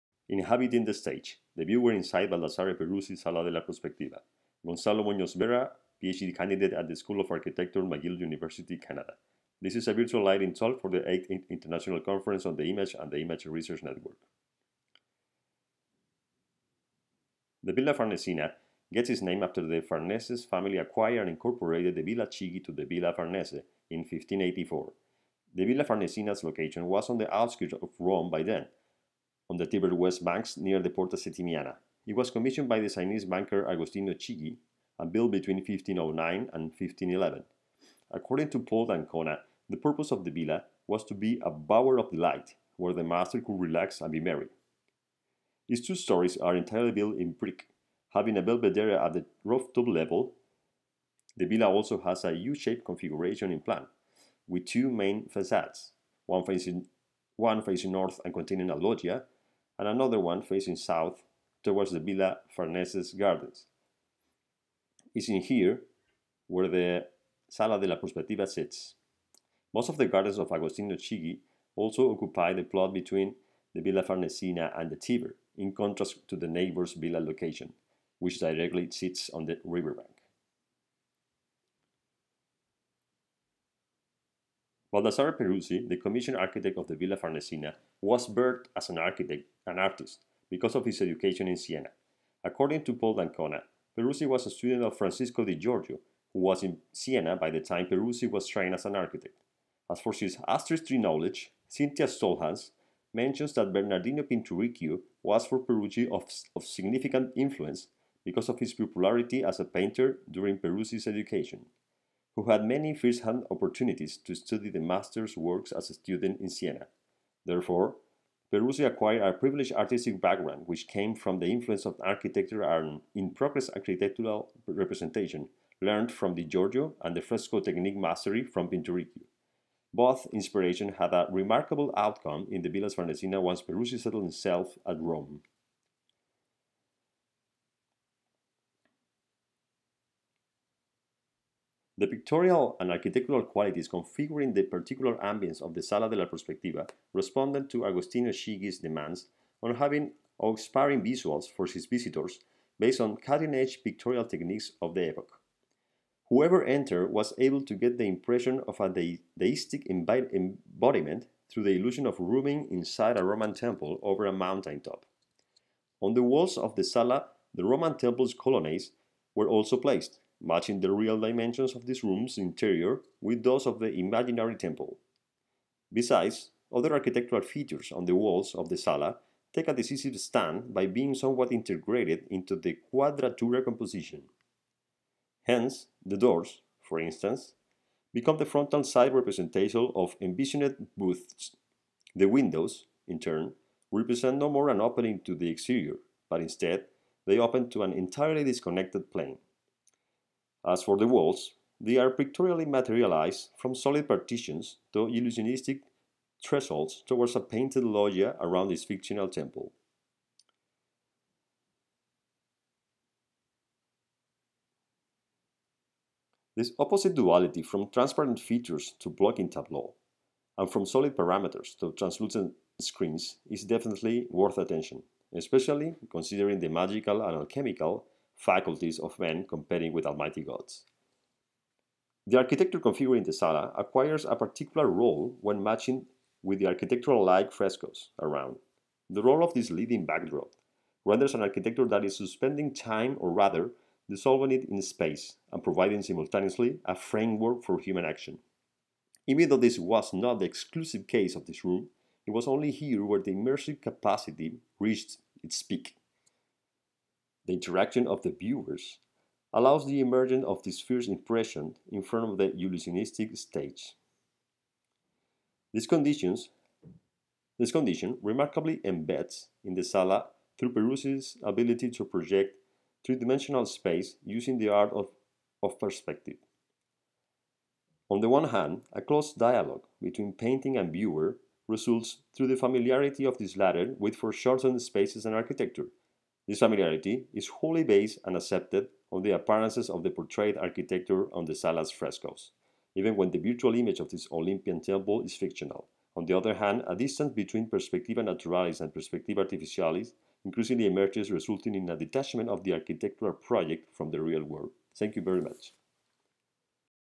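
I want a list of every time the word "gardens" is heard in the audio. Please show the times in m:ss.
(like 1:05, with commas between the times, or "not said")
1:03, 1:10.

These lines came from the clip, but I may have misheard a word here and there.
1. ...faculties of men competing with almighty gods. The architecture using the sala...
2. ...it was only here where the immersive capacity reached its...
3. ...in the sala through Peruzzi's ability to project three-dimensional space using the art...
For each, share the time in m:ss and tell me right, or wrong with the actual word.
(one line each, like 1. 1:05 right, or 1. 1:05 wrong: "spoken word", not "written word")
1. 3:48 wrong: "configuring", not "using"
2. 4:12 right
3. 4:29 right.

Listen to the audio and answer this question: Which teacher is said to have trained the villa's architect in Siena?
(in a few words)
Francisco di Giorgio.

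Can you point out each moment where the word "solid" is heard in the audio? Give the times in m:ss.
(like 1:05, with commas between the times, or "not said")
3:23, 3:40.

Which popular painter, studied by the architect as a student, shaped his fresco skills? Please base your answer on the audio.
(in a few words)
Bernardino Pinturicchio.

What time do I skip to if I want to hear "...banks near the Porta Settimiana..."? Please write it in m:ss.
0:30.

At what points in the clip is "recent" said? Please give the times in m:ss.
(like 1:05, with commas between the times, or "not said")
not said.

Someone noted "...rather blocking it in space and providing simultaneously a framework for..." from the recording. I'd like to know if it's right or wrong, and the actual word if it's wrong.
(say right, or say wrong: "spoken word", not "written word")
wrong: "dissolving", not "blocking".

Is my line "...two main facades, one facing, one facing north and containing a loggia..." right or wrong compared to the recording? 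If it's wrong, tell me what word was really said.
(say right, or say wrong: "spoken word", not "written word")
right.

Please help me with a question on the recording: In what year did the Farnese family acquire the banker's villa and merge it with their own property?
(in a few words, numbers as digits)
1584.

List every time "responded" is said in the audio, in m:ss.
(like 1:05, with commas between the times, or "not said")
2:27.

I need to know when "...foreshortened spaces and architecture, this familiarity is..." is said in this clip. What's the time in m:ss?
4:44.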